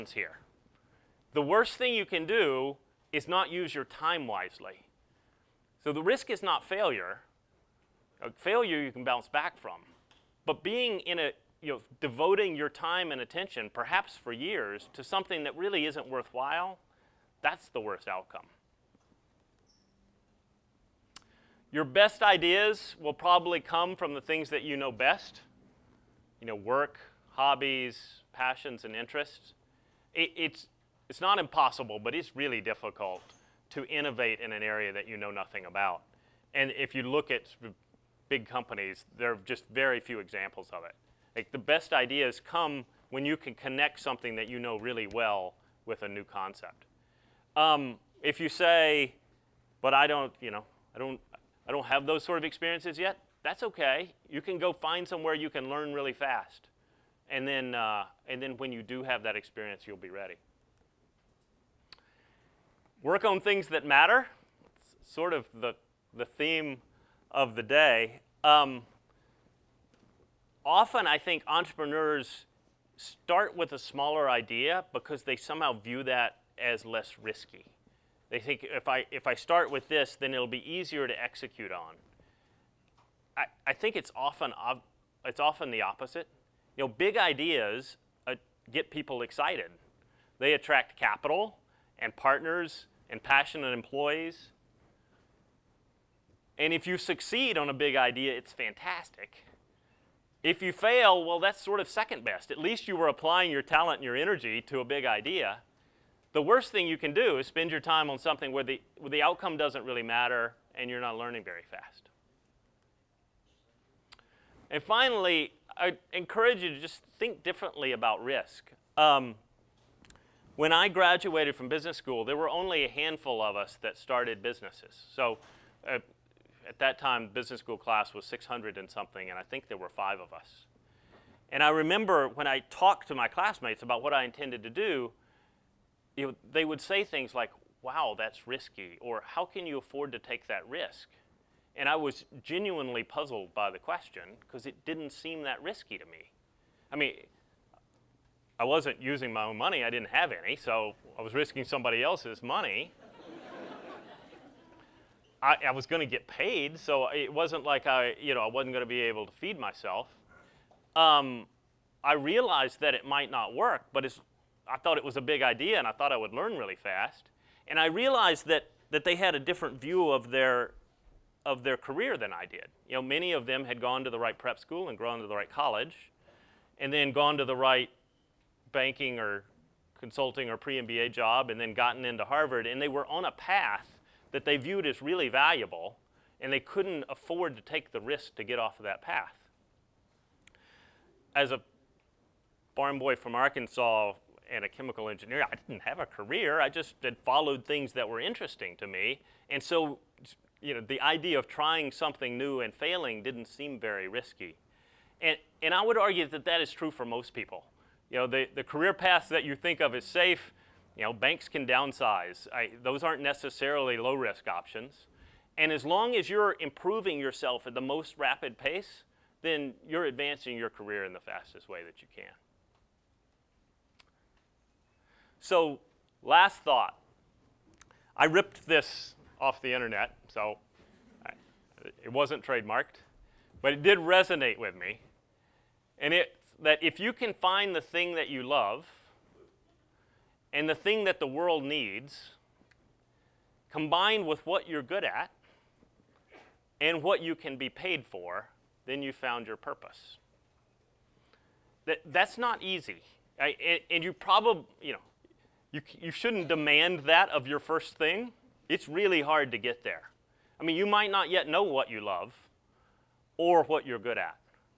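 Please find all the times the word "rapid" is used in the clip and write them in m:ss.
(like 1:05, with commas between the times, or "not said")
3:38.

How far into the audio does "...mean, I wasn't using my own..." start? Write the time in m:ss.
2:26.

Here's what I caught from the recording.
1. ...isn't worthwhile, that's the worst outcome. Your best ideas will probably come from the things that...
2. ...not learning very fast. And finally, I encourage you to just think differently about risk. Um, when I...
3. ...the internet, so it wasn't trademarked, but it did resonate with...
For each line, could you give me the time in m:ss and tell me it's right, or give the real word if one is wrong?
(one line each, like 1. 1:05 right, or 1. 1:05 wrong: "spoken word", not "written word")
1. 0:15 right
2. 1:51 right
3. 3:49 right.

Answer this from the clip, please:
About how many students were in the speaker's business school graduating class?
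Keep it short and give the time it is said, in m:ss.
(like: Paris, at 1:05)
600 and something, at 2:08.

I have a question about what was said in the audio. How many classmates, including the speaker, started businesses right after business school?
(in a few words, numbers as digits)
5.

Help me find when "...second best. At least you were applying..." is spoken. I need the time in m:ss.
1:41.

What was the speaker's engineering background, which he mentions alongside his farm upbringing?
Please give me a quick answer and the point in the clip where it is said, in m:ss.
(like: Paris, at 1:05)
chemical engineer, at 3:14.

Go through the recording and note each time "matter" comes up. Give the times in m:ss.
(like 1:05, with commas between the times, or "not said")
1:03, 1:50.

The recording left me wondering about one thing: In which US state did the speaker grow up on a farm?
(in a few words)
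Arkansas.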